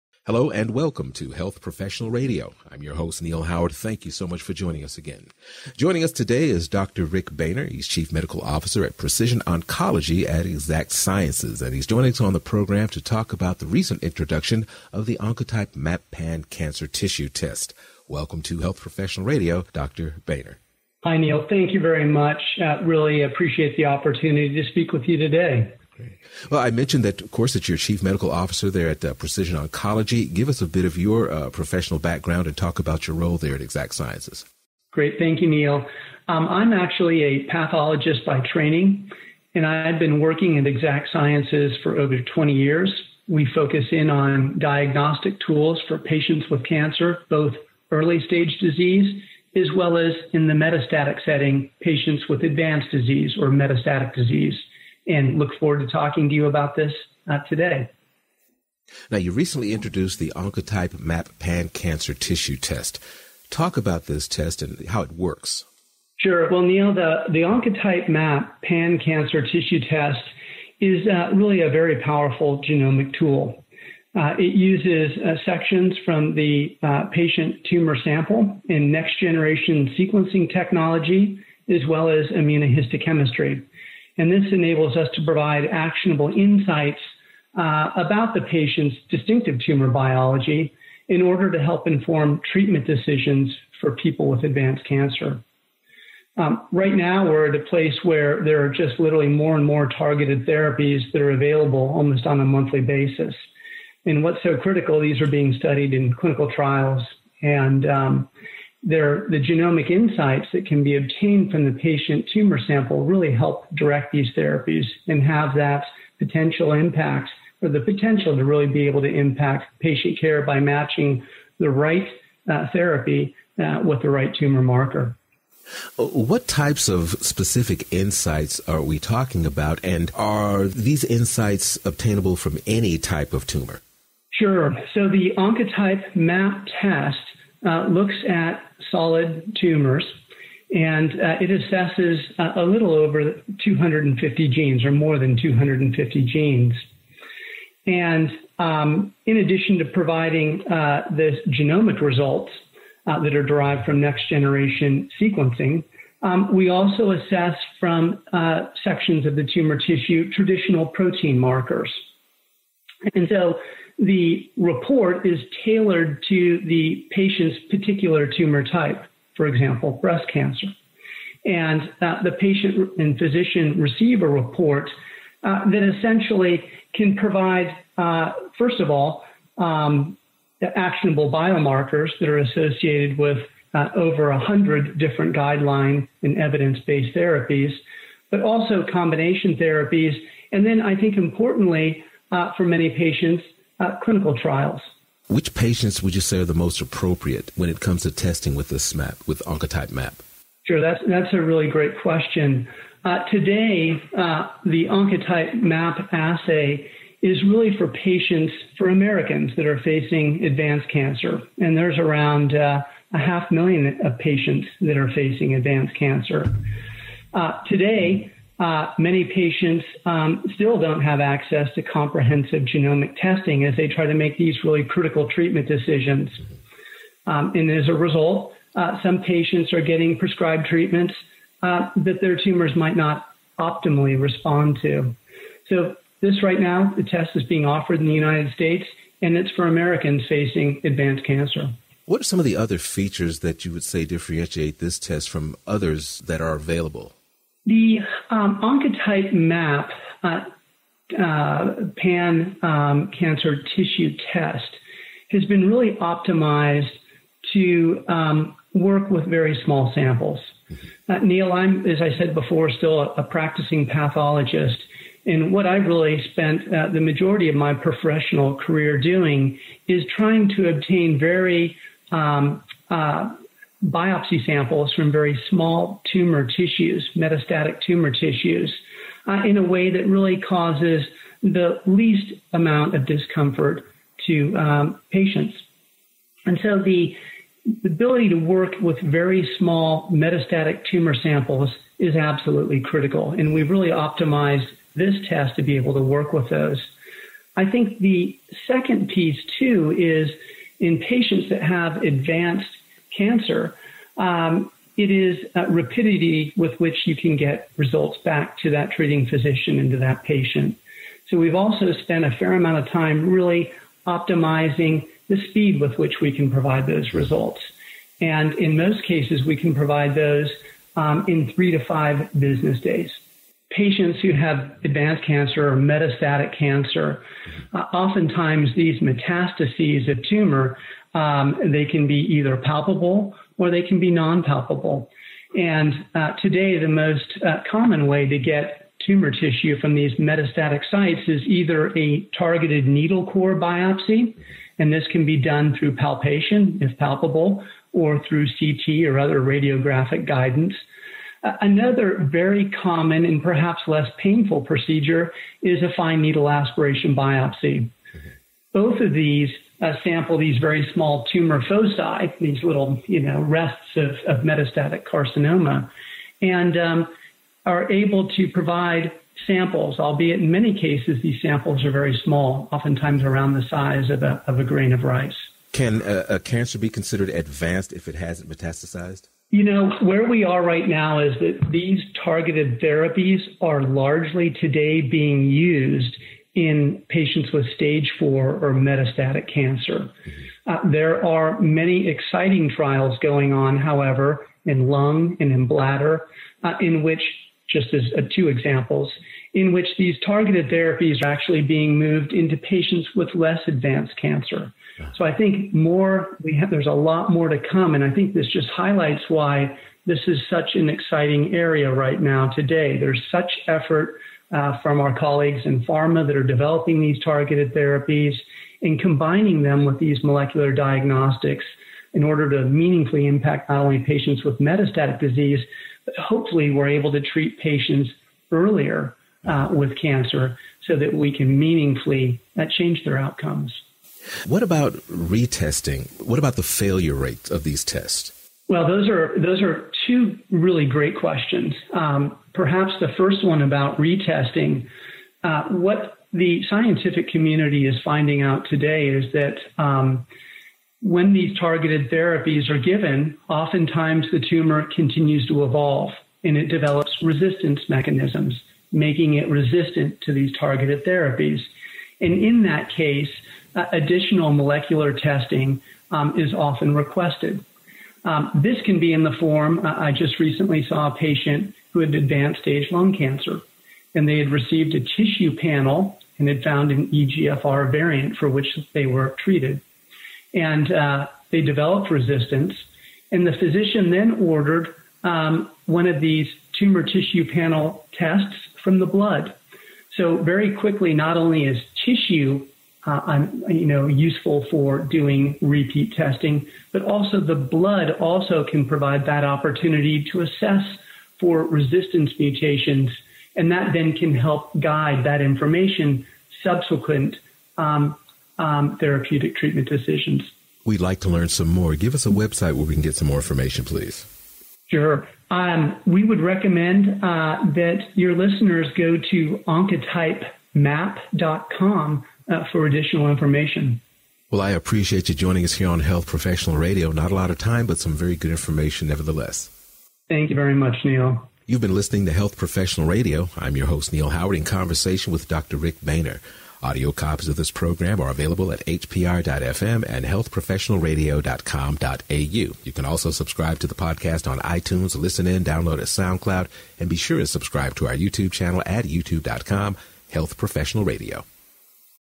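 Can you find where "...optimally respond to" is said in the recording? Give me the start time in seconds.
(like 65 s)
233 s.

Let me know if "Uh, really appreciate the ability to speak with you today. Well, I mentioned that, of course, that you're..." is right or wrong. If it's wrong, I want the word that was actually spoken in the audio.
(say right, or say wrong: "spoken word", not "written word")
wrong: "opportunity", not "ability".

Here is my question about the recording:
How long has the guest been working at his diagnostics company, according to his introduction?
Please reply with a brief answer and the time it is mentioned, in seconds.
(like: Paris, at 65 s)
Over 20 years, at 41 s.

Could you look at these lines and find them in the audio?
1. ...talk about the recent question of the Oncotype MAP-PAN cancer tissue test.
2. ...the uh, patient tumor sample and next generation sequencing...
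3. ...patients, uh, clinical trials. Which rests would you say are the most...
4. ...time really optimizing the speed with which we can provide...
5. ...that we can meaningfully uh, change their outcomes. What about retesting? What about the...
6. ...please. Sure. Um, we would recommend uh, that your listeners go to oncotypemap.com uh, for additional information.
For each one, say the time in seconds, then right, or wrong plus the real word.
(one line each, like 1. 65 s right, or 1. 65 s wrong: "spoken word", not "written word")
1. 13 s wrong: "introduction", not "question"
2. 76 s right
3. 192 s wrong: "patients", not "rests"
4. 312 s right
5. 430 s right
6. 513 s right.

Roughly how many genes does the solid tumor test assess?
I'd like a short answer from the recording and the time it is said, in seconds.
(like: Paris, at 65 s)
More than 250, at 144 s.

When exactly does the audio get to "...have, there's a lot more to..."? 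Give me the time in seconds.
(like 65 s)
406 s.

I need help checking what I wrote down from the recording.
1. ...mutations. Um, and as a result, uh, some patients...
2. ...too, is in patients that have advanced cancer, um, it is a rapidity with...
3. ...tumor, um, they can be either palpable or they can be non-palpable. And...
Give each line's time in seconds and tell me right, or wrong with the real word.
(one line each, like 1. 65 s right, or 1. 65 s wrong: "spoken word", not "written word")
1. 225 s wrong: "decisions", not "mutations"
2. 299 s right
3. 330 s right.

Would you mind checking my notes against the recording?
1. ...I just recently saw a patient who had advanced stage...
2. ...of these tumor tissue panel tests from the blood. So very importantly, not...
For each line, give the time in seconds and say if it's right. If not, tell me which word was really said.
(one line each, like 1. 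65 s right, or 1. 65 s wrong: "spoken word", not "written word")
1. 469 s right
2. 486 s wrong: "quickly", not "importantly".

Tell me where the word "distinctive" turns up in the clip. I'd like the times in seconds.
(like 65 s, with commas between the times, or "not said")
89 s.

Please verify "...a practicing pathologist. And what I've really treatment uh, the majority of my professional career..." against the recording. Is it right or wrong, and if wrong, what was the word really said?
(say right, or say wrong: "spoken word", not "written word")
wrong: "spent", not "treatment".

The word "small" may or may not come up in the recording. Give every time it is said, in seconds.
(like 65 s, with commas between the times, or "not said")
259 s, 275 s, 289 s, 360 s, 372 s.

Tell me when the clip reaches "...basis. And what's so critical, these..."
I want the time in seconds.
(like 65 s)
102 s.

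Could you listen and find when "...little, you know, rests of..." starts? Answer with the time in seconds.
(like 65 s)
362 s.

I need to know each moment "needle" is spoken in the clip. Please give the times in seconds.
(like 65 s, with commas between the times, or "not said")
342 s, 356 s.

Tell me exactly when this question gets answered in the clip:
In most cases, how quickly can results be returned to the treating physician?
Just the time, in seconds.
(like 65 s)
321 s.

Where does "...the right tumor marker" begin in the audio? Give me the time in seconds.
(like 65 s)
124 s.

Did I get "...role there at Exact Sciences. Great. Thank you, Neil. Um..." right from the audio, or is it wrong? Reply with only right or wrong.
right.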